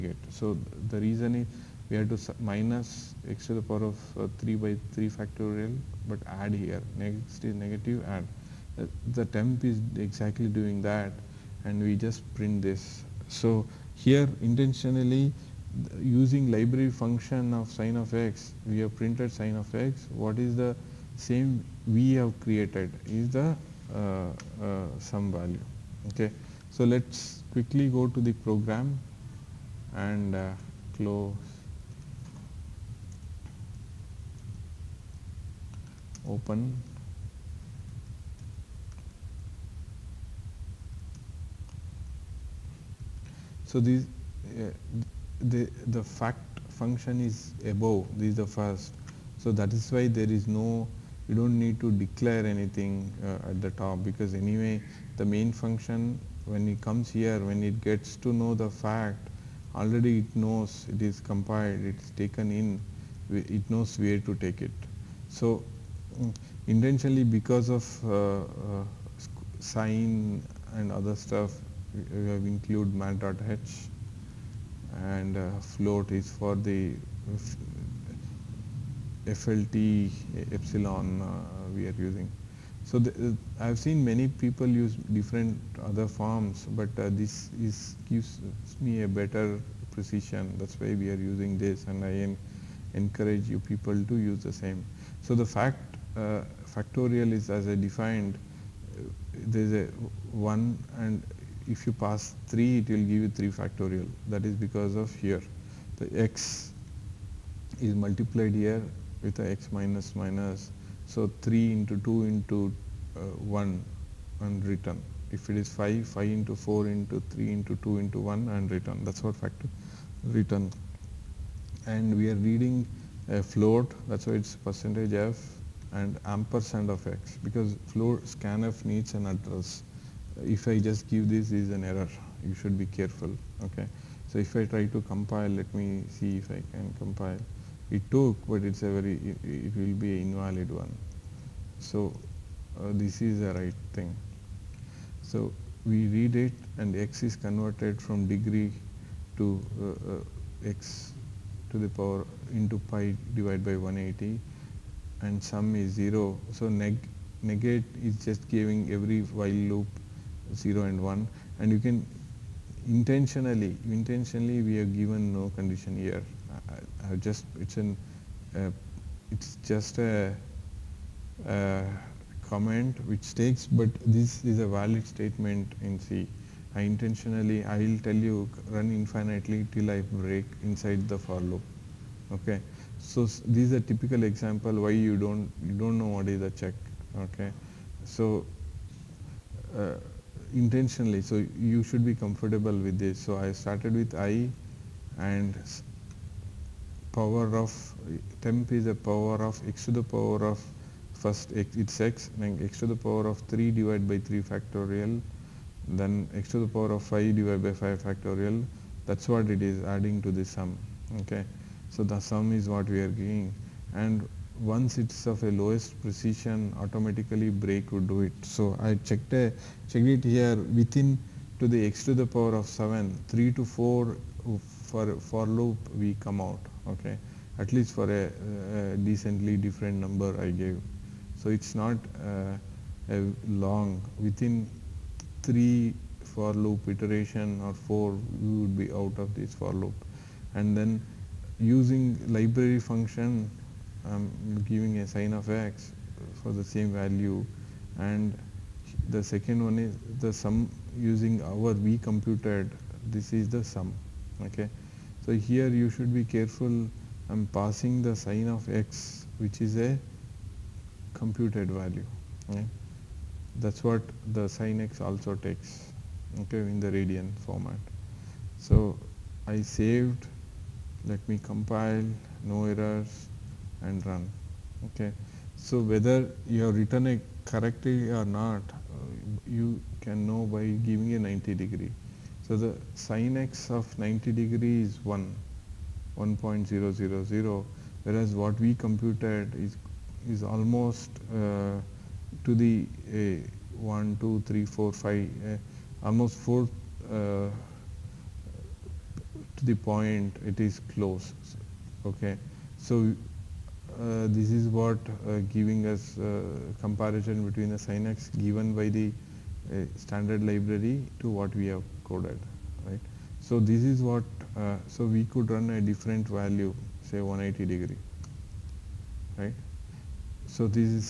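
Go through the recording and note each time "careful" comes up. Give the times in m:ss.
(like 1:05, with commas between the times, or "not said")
2:12, 4:16.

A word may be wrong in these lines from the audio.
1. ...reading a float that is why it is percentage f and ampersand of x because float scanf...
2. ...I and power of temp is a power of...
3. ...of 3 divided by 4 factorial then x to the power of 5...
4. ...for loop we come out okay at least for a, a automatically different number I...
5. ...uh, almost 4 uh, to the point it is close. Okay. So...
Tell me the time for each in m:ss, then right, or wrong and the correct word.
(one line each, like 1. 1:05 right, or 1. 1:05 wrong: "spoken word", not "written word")
1. 2:02 right
2. 3:14 right
3. 3:23 wrong: "3", not "4"
4. 3:45 wrong: "decently", not "automatically"
5. 4:55 right.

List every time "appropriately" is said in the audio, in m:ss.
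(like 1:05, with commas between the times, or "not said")
not said.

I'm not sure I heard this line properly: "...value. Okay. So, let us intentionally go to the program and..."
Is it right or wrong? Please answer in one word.
wrong.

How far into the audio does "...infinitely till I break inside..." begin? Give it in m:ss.
2:58.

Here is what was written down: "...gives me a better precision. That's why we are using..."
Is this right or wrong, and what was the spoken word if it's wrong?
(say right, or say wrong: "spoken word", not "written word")
right.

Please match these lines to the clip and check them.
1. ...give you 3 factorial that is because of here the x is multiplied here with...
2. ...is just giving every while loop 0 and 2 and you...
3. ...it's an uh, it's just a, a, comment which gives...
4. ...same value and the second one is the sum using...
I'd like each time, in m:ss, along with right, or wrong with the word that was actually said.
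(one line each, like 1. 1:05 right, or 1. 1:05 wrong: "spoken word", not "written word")
1. 1:43 right
2. 2:38 wrong: "1", not "2"
3. 2:47 wrong: "takes", not "gives"
4. 4:06 right.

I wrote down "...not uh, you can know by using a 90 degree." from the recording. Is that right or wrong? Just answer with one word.
wrong.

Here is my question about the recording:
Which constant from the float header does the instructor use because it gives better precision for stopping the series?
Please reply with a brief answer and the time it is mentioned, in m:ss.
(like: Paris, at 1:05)
FLT epsilon, at 1:19.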